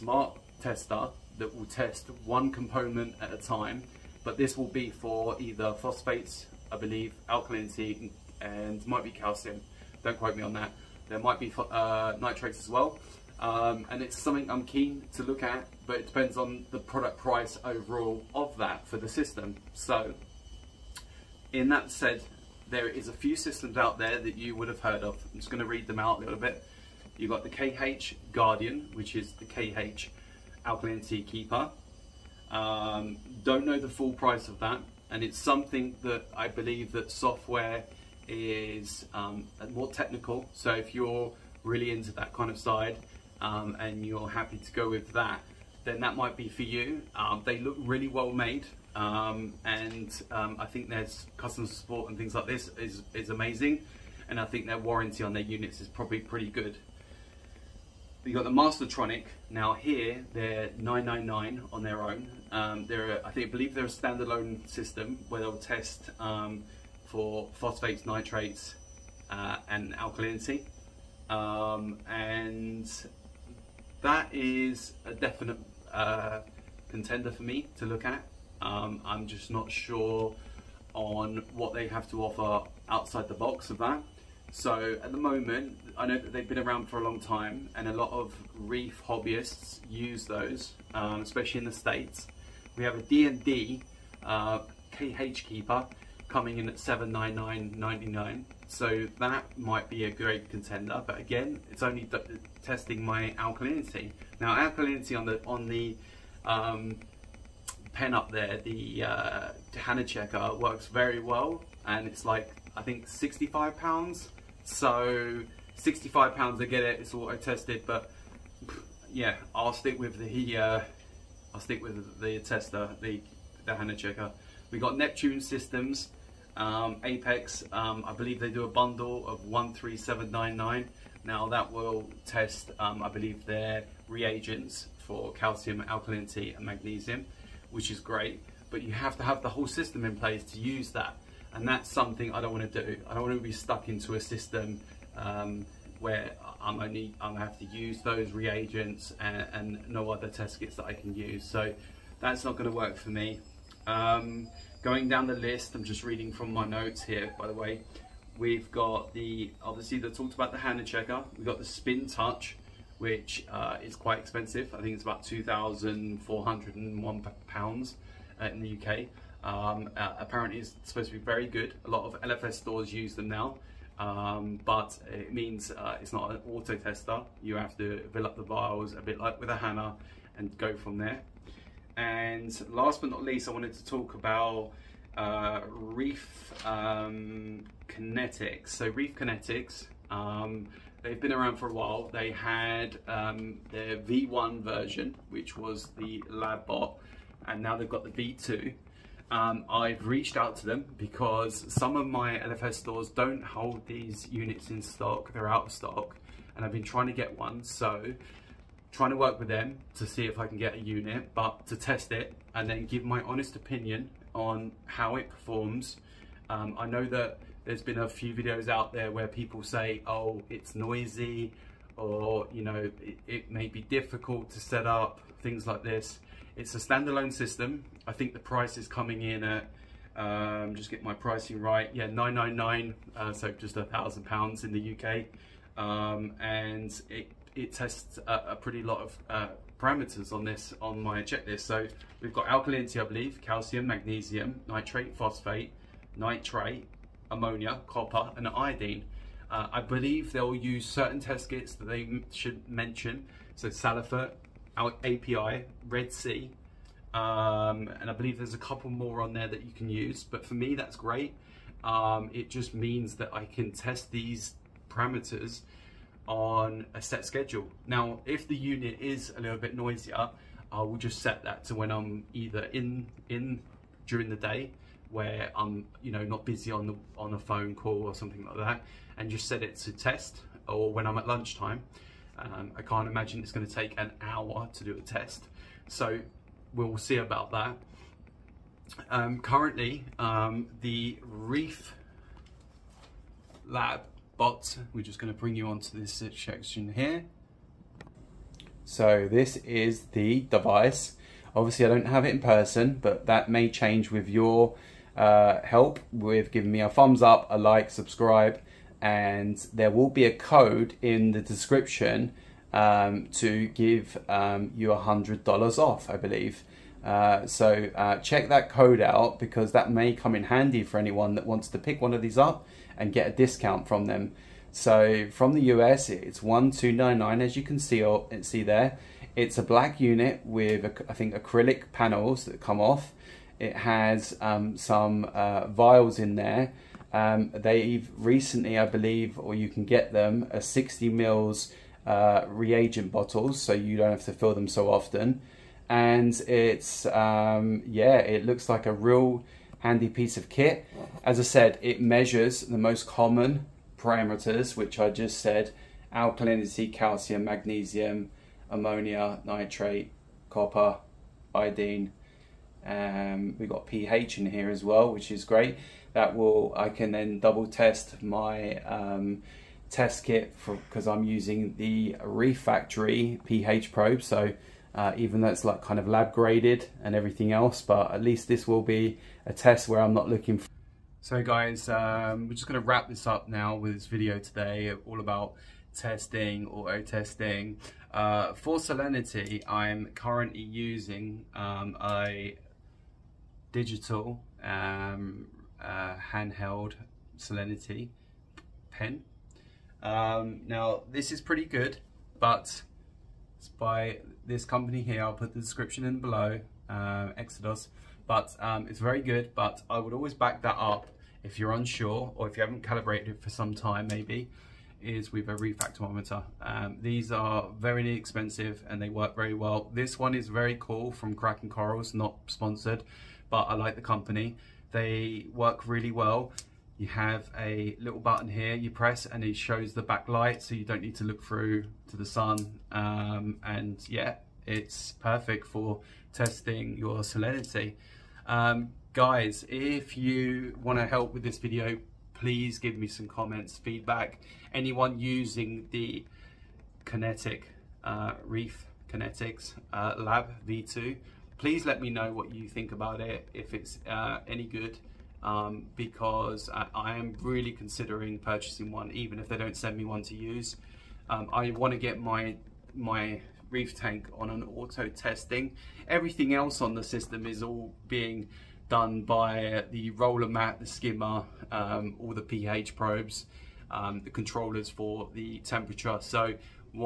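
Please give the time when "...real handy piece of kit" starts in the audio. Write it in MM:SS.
05:48.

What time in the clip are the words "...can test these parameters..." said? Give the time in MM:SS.
04:23.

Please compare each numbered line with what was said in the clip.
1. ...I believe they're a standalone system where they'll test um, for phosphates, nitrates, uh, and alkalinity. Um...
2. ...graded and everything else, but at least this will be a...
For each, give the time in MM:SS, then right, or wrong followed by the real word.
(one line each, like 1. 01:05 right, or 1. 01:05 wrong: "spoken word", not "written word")
1. 01:03 right
2. 06:16 right.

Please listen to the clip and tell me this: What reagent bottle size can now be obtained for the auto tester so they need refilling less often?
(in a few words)
60 ml.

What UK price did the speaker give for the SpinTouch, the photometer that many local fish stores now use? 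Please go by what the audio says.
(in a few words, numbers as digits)
£2,401.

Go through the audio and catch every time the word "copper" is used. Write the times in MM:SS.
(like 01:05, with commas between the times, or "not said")
04:07, 06:00.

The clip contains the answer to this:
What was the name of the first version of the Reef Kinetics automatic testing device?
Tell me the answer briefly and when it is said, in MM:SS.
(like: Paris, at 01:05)
LabBot, at 03:16.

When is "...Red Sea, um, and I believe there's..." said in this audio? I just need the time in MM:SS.
04:15.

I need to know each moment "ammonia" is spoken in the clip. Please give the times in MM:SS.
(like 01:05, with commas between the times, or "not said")
04:07, 05:58.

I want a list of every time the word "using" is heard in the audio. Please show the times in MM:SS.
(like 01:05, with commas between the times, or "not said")
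06:11, 06:30, 07:25.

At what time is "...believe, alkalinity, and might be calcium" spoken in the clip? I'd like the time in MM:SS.
00:06.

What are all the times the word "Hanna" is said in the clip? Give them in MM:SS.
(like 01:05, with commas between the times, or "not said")
02:40, 02:59.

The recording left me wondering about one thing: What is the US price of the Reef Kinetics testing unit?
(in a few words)
1299.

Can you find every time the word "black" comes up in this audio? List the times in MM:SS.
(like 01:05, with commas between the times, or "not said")
05:29.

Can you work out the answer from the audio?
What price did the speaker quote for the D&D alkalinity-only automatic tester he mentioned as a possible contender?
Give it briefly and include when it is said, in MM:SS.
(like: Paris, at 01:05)
799.99, at 01:36.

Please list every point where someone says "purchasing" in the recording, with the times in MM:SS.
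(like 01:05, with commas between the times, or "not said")
07:38.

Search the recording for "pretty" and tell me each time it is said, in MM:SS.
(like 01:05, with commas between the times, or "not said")
00:56, 03:58, 06:41.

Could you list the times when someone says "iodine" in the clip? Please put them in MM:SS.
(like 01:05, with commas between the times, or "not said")
04:08, 06:01.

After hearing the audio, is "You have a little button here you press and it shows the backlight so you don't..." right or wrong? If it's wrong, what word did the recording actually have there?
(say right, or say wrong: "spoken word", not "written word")
right.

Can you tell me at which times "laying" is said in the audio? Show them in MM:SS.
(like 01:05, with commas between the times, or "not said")
not said.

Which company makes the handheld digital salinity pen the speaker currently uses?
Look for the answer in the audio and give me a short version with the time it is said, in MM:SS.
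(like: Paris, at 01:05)
Exodus, at 06:47.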